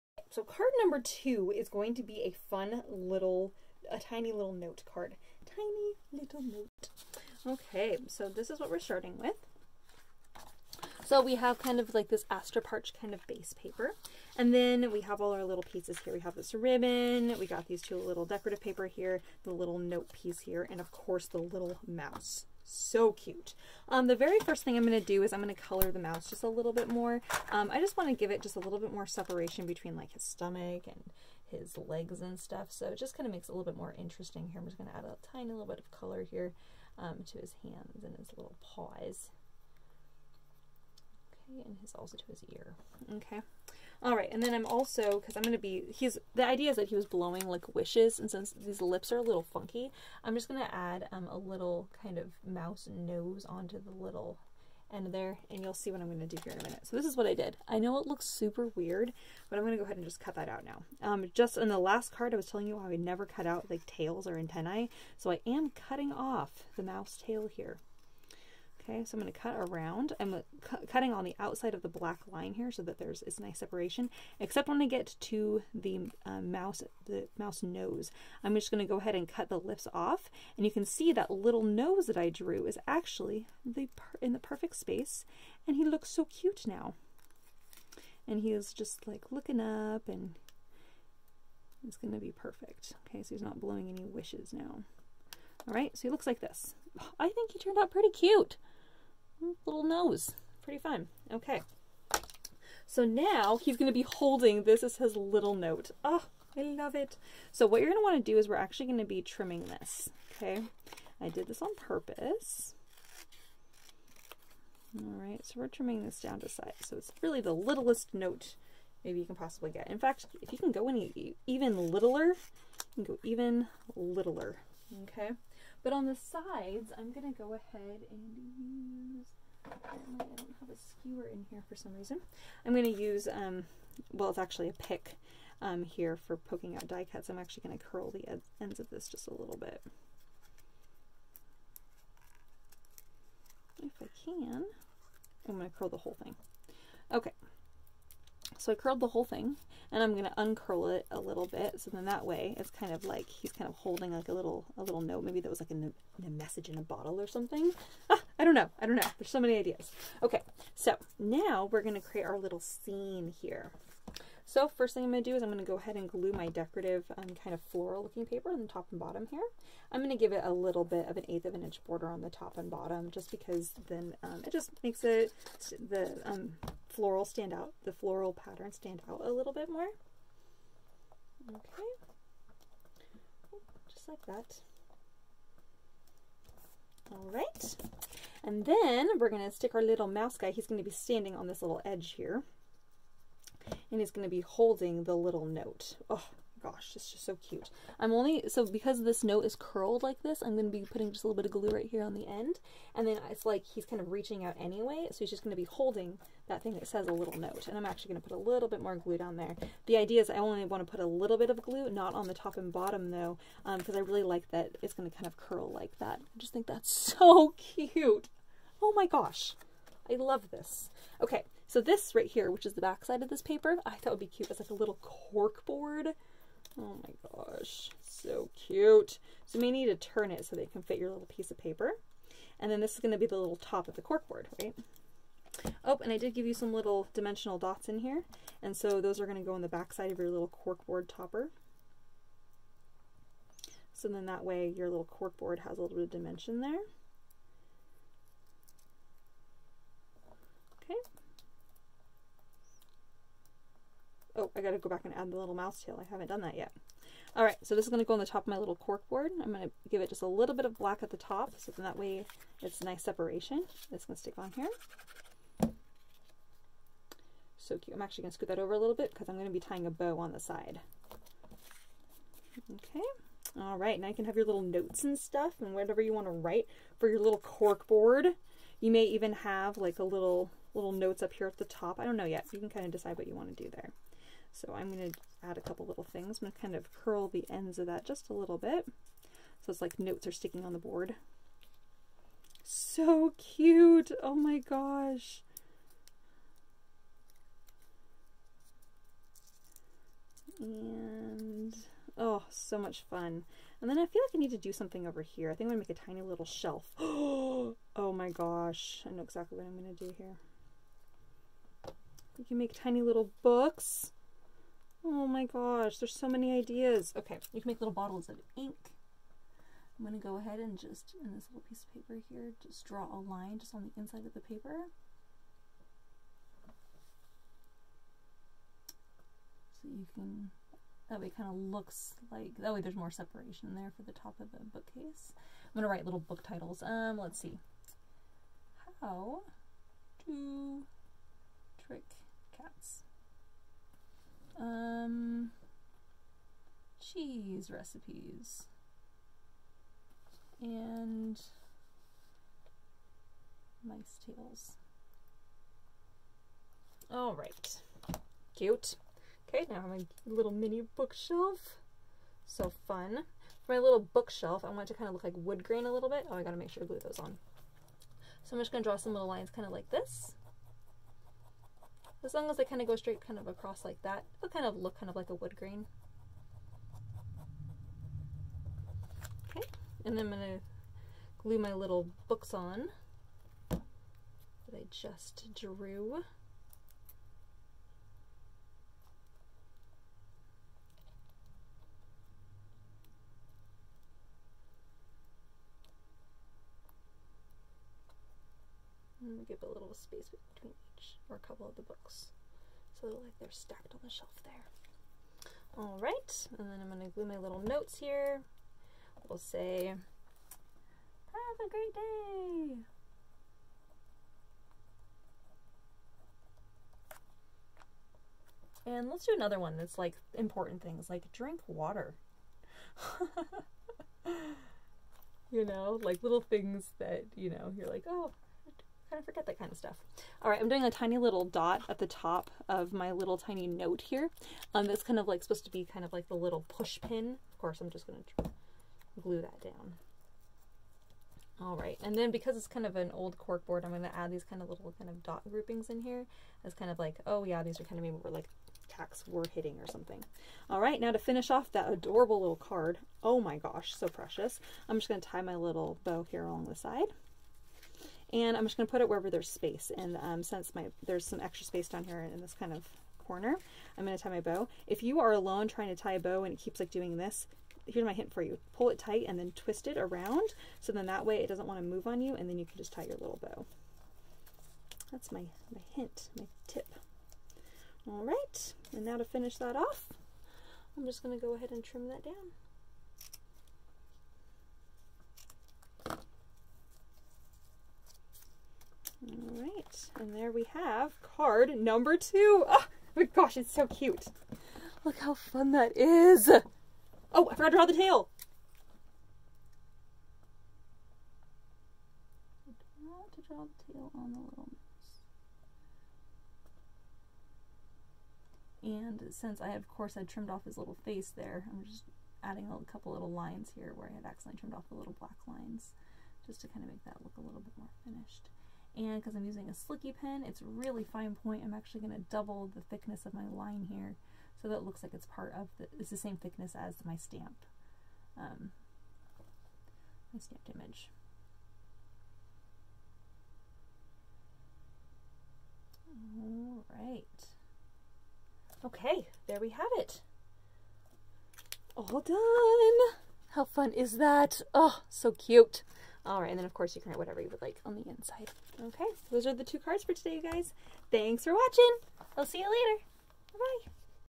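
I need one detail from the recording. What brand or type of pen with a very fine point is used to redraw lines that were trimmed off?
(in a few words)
Slicky pen.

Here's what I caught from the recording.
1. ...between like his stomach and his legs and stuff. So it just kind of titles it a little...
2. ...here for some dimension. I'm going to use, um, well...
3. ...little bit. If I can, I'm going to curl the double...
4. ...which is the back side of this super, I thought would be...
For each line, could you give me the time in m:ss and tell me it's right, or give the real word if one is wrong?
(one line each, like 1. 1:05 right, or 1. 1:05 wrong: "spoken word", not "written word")
1. 0:29 wrong: "makes", not "titles"
2. 2:11 wrong: "reason", not "dimension"
3. 2:19 wrong: "whole", not "double"
4. 3:42 wrong: "paper", not "super".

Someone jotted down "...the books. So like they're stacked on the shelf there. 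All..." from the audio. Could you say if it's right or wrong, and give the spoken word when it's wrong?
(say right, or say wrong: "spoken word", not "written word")
right.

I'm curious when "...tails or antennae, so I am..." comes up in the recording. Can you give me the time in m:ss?
1:03.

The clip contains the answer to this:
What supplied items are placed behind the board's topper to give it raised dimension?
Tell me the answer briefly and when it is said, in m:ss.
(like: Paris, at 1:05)
Dimensional dots, at 3:57.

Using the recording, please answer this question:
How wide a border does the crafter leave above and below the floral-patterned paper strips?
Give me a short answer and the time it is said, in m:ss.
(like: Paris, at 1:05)
An eighth of an inch, at 2:51.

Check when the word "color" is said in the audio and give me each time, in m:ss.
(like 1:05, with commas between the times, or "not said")
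0:25, 0:35.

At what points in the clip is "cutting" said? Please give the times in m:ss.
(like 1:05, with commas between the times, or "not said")
1:05, 1:10.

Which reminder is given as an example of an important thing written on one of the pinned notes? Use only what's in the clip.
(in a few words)
Drink water.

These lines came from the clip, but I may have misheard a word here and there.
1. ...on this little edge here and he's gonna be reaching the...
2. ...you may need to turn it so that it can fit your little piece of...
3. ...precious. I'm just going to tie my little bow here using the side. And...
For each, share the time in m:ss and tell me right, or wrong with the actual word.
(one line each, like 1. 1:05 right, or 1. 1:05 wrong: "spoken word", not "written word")
1. 3:11 wrong: "holding", not "reaching"
2. 3:49 right
3. 7:34 wrong: "along", not "using".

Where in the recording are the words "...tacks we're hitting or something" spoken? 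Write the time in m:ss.
7:28.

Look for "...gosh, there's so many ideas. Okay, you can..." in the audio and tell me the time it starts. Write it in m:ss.
5:15.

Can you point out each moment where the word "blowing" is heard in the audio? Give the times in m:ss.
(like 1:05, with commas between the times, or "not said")
0:47, 1:33.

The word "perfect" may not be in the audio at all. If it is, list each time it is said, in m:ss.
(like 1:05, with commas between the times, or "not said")
1:24, 1:32.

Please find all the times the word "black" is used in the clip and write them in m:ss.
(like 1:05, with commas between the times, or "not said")
1:11, 4:20, 8:35.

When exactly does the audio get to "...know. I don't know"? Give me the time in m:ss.
2:38.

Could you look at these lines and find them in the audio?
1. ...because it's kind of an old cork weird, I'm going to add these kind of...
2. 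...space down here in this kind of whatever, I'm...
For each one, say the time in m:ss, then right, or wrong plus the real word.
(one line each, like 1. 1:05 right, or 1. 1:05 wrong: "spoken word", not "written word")
1. 7:22 wrong: "board", not "weird"
2. 7:41 wrong: "corner", not "whatever".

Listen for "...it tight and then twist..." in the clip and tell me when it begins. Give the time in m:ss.
7:48.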